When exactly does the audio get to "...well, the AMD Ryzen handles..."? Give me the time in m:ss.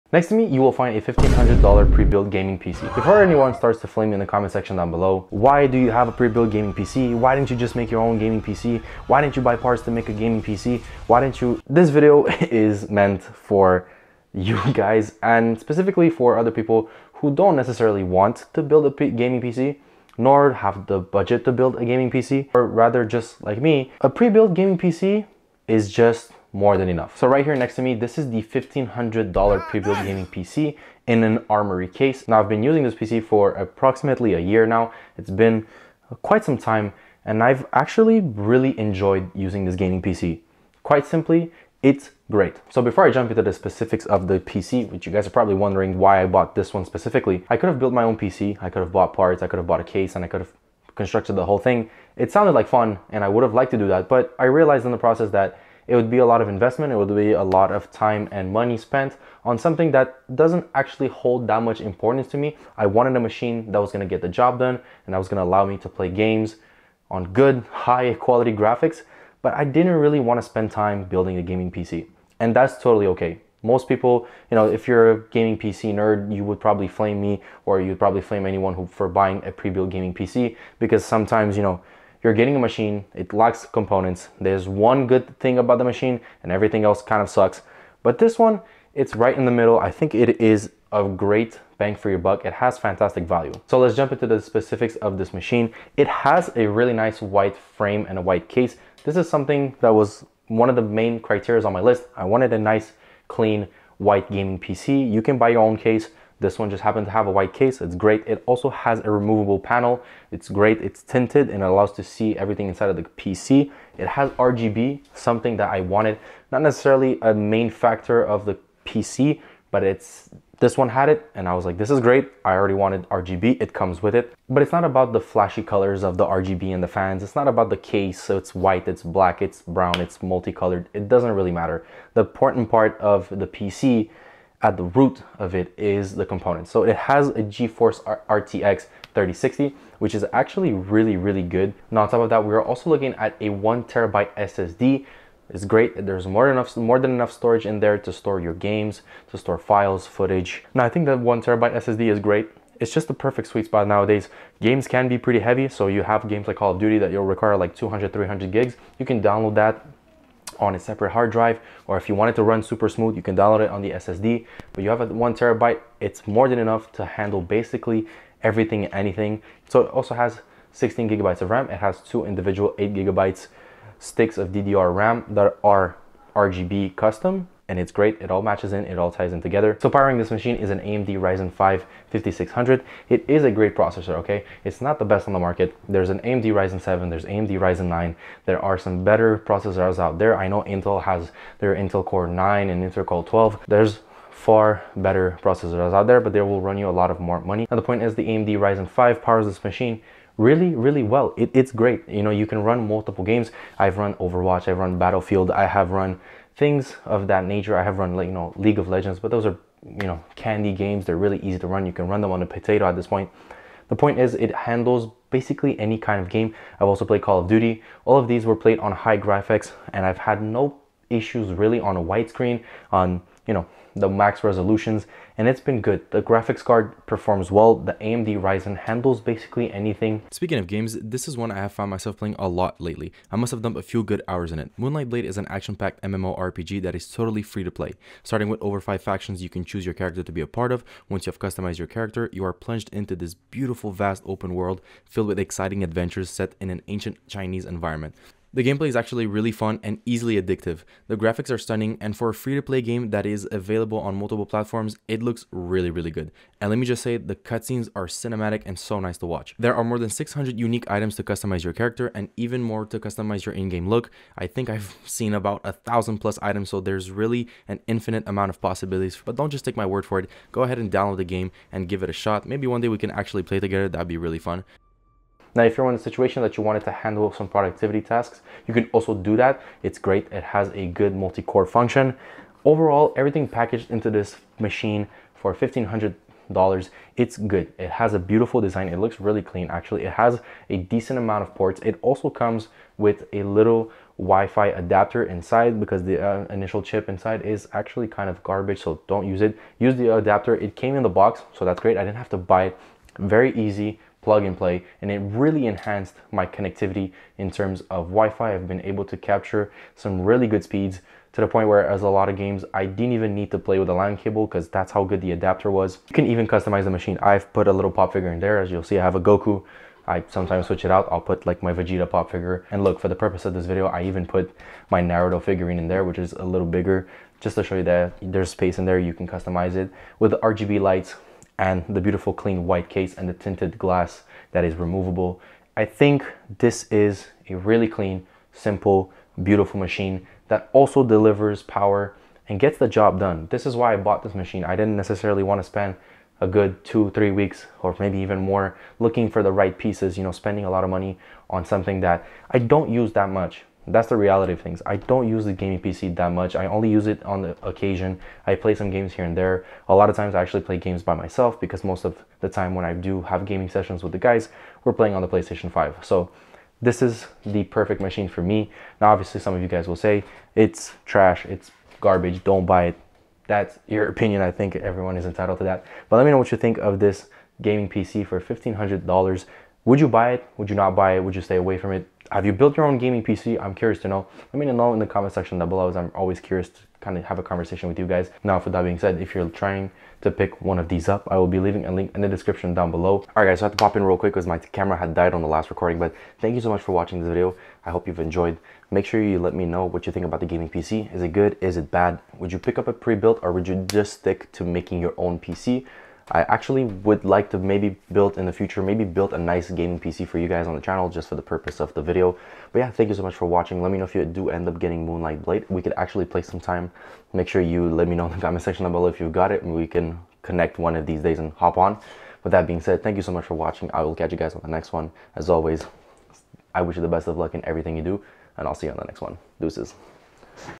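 3:47.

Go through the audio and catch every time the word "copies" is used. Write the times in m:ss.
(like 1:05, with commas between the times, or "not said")
not said.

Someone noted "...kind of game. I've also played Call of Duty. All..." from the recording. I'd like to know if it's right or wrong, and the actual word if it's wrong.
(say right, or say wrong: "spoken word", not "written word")
right.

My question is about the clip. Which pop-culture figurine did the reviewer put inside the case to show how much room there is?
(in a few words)
Naruto.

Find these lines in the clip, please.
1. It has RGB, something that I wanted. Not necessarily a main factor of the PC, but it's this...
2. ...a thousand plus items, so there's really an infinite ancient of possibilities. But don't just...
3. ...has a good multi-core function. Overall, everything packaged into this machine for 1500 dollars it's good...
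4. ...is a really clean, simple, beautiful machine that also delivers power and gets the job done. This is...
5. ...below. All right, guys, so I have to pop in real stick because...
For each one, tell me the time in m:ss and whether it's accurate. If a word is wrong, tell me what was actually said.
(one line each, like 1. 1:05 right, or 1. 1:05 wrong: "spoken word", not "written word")
1. 1:53 right
2. 4:25 wrong: "amount", not "ancient"
3. 4:40 right
4. 5:36 right
5. 6:32 wrong: "quick", not "stick".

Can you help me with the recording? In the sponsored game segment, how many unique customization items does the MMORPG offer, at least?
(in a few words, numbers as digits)
600.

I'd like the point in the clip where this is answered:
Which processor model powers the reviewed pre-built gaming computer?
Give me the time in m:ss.
3:00.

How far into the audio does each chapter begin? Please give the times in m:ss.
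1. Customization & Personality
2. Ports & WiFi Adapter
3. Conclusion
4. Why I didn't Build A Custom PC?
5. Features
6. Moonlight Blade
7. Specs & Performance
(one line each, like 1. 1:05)
1. 5:15
2. 4:37
3. 5:39
4. 0:35
5. 1:40
6. 3:52
7. 2:17.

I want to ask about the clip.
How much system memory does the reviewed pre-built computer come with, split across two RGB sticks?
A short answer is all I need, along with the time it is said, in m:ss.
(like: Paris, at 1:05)
16 gigabytes, at 2:50.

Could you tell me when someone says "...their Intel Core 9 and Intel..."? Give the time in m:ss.
3:11.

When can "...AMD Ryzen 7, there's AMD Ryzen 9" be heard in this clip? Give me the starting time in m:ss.
3:06.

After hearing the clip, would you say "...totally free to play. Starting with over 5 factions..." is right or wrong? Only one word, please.
right.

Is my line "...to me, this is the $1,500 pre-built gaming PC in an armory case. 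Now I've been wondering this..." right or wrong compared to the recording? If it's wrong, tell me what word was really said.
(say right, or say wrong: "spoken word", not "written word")
wrong: "using", not "wondering".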